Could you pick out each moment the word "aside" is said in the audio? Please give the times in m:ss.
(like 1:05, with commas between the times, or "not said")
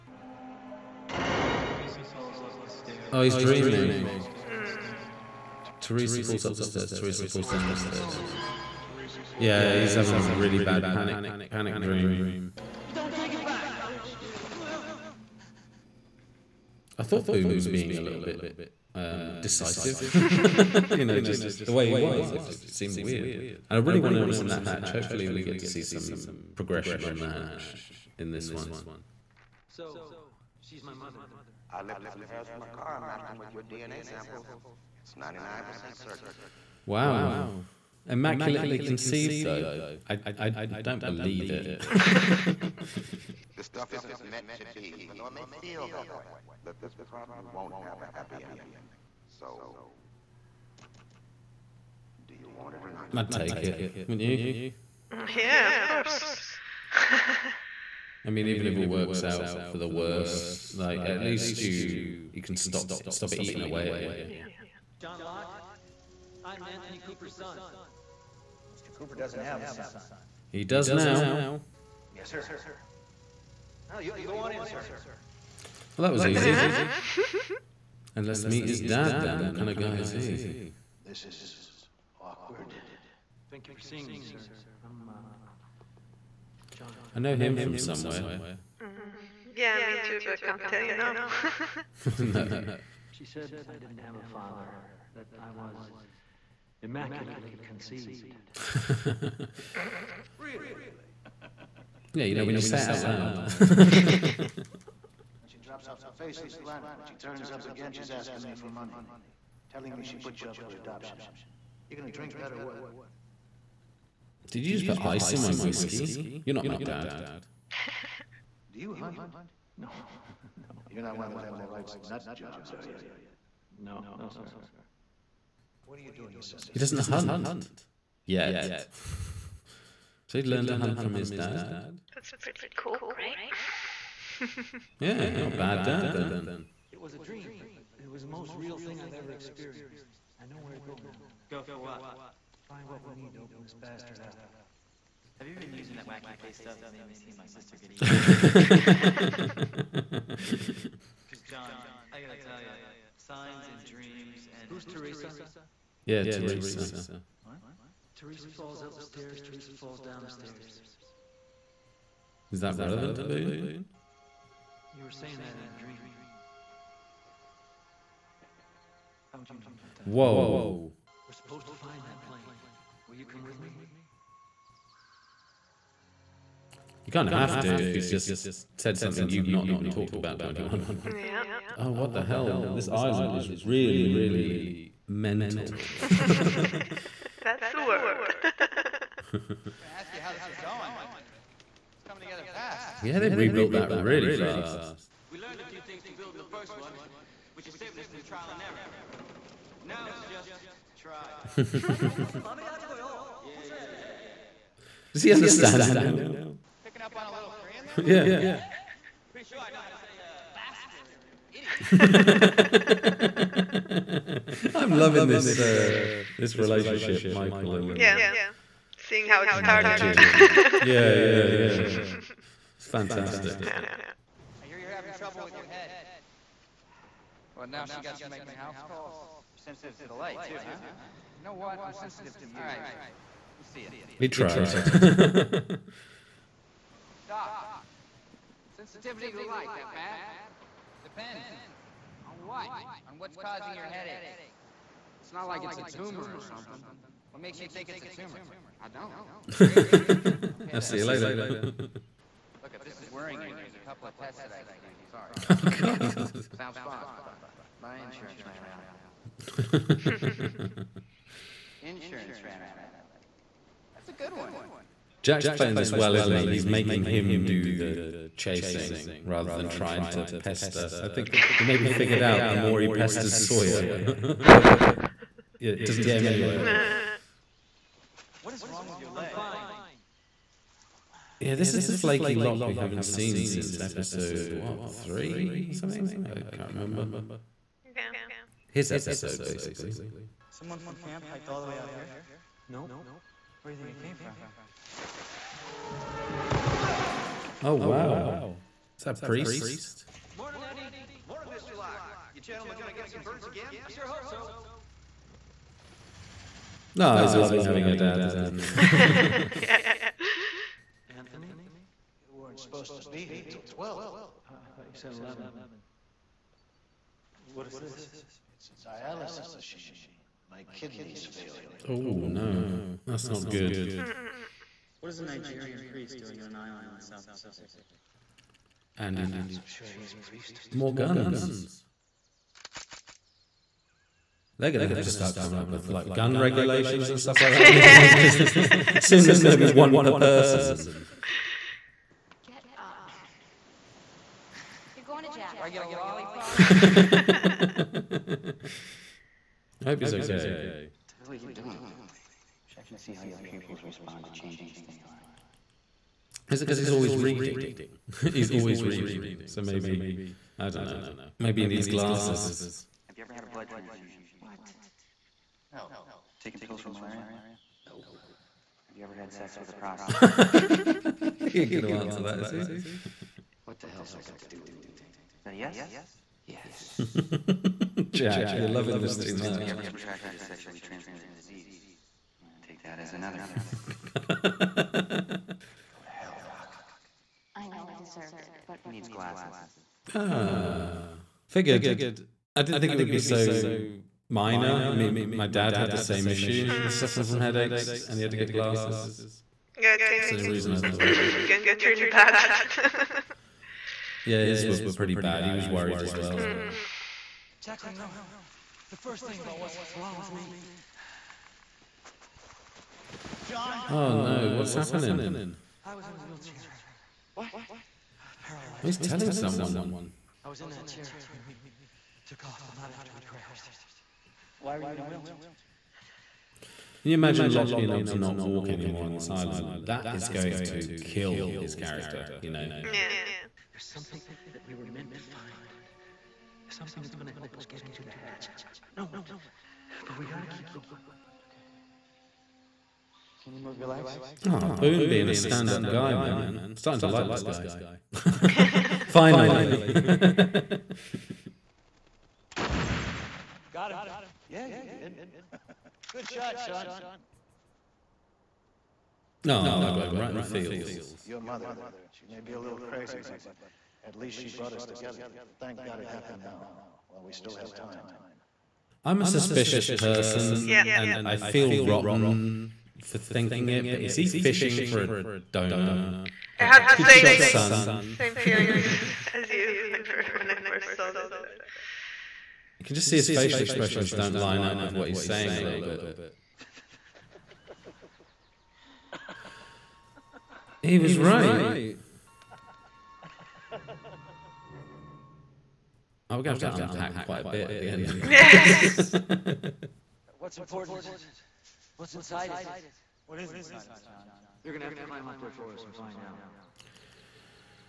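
not said.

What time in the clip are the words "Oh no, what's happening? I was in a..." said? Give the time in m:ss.
6:53.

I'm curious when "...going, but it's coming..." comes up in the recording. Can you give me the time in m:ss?
3:10.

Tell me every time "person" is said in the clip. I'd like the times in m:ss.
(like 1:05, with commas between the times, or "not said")
5:40, 7:49.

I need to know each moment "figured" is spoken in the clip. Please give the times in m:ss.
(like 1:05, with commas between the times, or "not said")
4:31, 6:31.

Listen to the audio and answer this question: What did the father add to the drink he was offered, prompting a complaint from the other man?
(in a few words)
Ice.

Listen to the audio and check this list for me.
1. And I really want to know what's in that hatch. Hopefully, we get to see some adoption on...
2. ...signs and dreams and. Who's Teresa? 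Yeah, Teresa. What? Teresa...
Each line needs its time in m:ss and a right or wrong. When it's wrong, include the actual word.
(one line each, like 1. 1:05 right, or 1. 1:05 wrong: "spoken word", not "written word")
1. 0:23 wrong: "progression", not "adoption"
2. 2:33 right.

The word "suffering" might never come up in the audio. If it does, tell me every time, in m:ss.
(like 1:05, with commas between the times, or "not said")
6:36.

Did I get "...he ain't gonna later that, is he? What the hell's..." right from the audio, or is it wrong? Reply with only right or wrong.
wrong.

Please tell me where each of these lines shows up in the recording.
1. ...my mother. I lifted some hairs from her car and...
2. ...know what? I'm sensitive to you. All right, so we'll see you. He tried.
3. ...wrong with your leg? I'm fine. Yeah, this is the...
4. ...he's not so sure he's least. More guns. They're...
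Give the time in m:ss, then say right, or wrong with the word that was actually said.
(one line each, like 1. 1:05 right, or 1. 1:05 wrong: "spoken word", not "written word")
1. 0:30 right
2. 3:51 right
3. 4:38 right
4. 5:29 wrong: "priest", not "least".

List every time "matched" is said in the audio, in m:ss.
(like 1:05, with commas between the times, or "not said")
0:33.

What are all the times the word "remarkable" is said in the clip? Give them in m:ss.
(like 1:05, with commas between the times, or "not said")
not said.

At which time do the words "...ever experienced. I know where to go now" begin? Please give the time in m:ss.
2:19.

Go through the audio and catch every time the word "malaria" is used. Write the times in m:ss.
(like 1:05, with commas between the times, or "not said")
6:06.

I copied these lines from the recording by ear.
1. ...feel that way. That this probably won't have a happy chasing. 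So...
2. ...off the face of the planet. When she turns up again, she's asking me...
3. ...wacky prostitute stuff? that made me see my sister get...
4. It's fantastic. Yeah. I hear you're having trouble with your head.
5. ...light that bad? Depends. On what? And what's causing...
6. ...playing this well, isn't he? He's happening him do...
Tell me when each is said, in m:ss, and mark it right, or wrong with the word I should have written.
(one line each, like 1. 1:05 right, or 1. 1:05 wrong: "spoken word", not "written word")
1. 0:45 wrong: "ending", not "chasing"
2. 1:45 right
3. 2:26 wrong: "paste", not "prostitute"
4. 3:42 right
5. 3:59 right
6. 4:25 wrong: "making", not "happening".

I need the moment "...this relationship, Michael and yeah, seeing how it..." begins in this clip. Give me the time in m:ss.
3:36.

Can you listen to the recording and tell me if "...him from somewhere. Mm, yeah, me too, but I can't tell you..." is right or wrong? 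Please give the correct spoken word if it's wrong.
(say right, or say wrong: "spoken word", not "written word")
right.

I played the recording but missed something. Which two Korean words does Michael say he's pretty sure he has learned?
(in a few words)
Bastard and idiot.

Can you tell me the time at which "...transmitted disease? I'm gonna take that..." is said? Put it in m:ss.
6:20.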